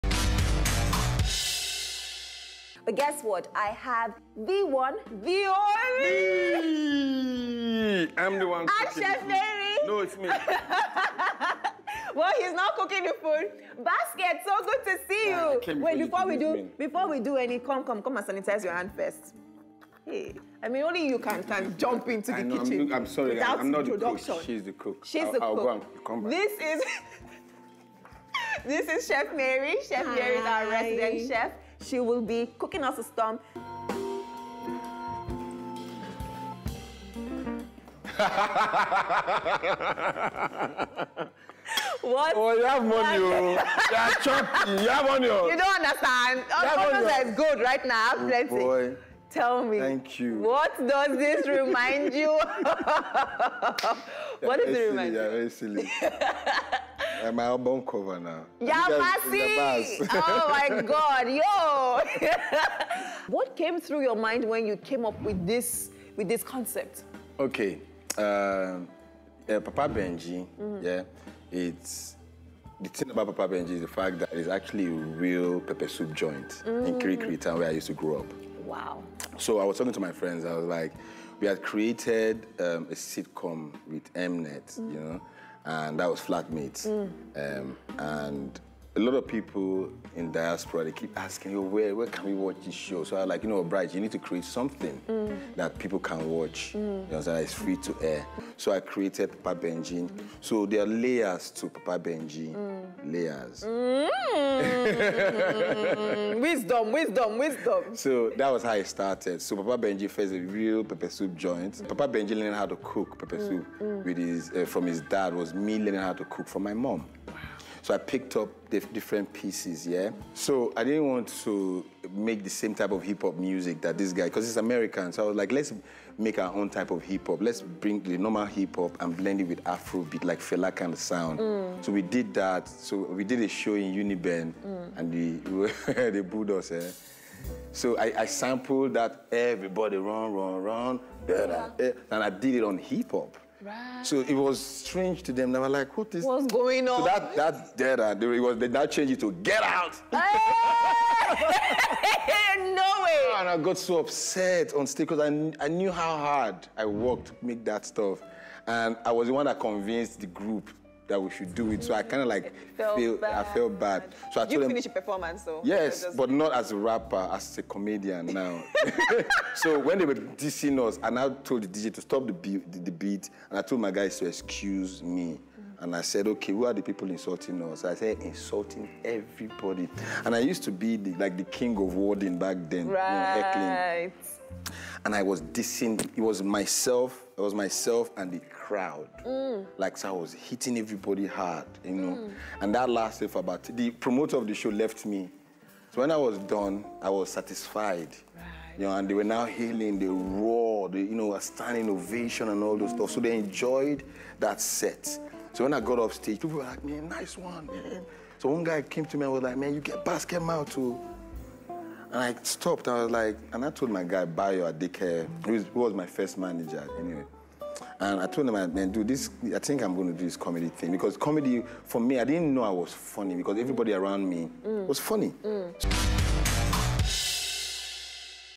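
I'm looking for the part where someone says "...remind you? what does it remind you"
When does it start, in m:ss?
0:51.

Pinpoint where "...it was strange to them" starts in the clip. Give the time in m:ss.
2:24.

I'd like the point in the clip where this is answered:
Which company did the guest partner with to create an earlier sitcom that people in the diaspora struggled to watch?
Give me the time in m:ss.
1:24.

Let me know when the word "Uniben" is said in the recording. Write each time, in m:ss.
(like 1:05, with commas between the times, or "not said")
2:13.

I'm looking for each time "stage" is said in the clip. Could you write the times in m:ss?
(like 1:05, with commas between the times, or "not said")
2:34, 3:26.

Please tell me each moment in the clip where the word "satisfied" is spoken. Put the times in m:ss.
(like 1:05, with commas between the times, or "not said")
3:17.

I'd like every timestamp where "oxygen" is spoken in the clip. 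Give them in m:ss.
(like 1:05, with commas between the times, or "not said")
not said.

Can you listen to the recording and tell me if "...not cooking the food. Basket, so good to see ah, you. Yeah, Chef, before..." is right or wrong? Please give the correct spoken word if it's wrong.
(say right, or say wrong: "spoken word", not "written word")
wrong: "Wait", not "Chef".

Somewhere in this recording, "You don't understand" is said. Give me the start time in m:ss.
0:45.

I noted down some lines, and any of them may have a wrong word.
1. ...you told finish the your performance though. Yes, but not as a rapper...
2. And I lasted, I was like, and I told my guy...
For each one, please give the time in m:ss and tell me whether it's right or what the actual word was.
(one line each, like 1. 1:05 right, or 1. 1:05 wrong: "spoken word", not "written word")
1. 2:44 right
2. 3:32 wrong: "stopped", not "lasted".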